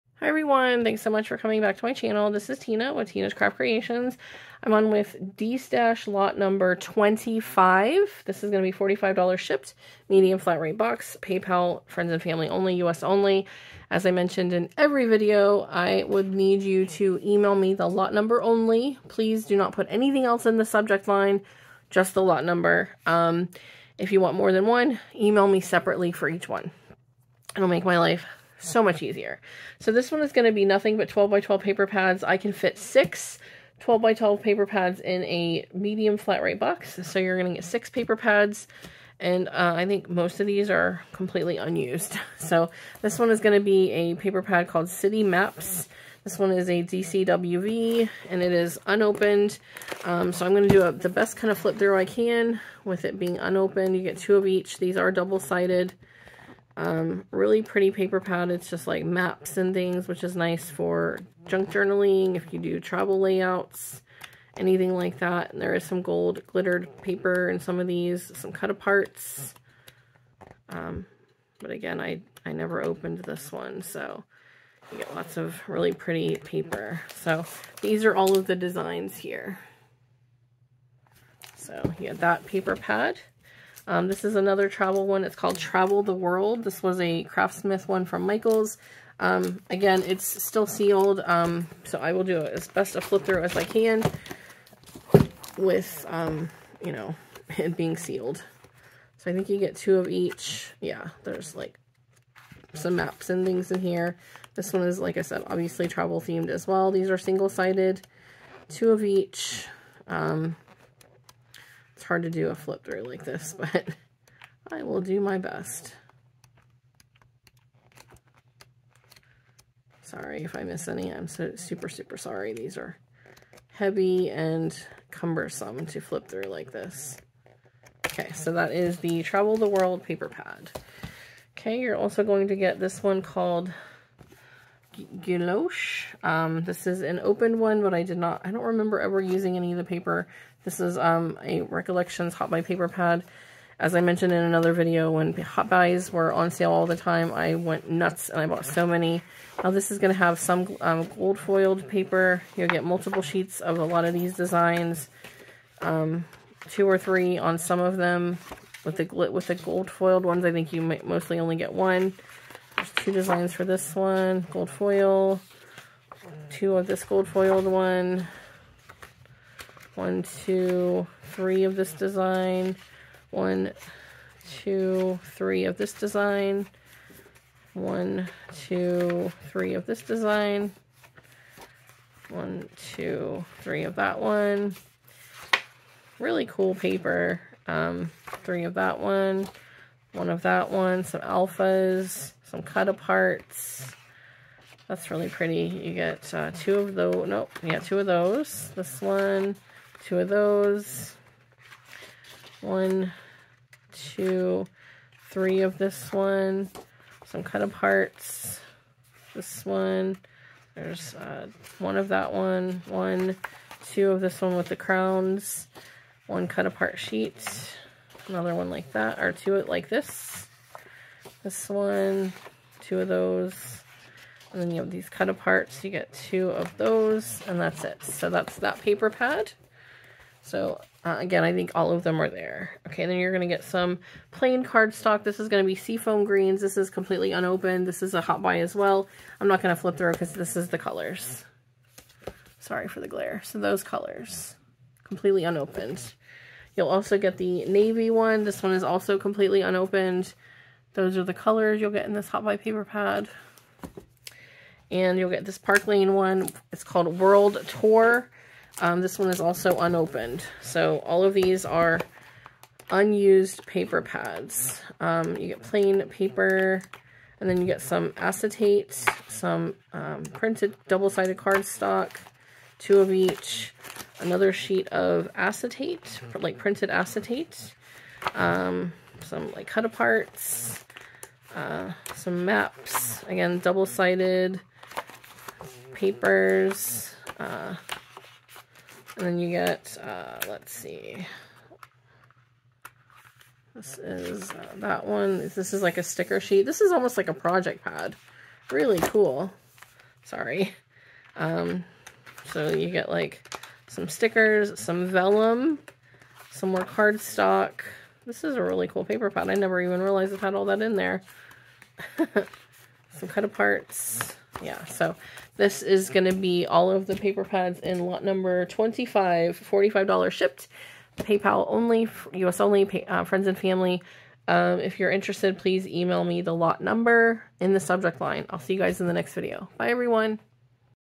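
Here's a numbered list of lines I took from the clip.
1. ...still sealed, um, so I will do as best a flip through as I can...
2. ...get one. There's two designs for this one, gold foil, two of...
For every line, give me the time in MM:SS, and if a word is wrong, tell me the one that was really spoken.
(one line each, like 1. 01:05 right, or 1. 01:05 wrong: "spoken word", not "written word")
1. 01:30 right
2. 02:41 right.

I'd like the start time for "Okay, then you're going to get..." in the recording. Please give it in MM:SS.
03:52.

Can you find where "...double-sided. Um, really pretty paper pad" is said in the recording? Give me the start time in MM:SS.
00:55.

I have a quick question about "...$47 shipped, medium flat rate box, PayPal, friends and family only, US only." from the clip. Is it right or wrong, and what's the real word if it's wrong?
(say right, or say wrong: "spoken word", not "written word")
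wrong: "45", not "47".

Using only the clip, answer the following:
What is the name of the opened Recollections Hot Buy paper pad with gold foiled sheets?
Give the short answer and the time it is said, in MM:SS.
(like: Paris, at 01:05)
Gouache, at 02:15.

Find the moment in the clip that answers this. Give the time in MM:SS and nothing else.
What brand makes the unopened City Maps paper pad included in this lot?
00:46.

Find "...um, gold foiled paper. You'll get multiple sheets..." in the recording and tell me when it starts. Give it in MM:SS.
02:30.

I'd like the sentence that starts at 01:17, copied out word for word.
So these are all of the designs here.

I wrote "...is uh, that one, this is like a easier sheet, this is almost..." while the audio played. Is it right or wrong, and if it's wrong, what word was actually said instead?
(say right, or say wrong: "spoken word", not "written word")
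wrong: "sticker", not "easier".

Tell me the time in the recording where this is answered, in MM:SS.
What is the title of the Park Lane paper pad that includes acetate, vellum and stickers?
04:17.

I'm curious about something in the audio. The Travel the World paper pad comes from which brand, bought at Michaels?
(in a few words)
Craft Smart.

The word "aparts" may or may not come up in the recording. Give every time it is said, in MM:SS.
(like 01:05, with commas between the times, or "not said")
01:08, 03:12, 03:27, 03:36, 03:45, 04:39, 05:13.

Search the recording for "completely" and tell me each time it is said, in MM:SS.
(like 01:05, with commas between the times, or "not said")
00:41, 03:56, 04:05, 04:09.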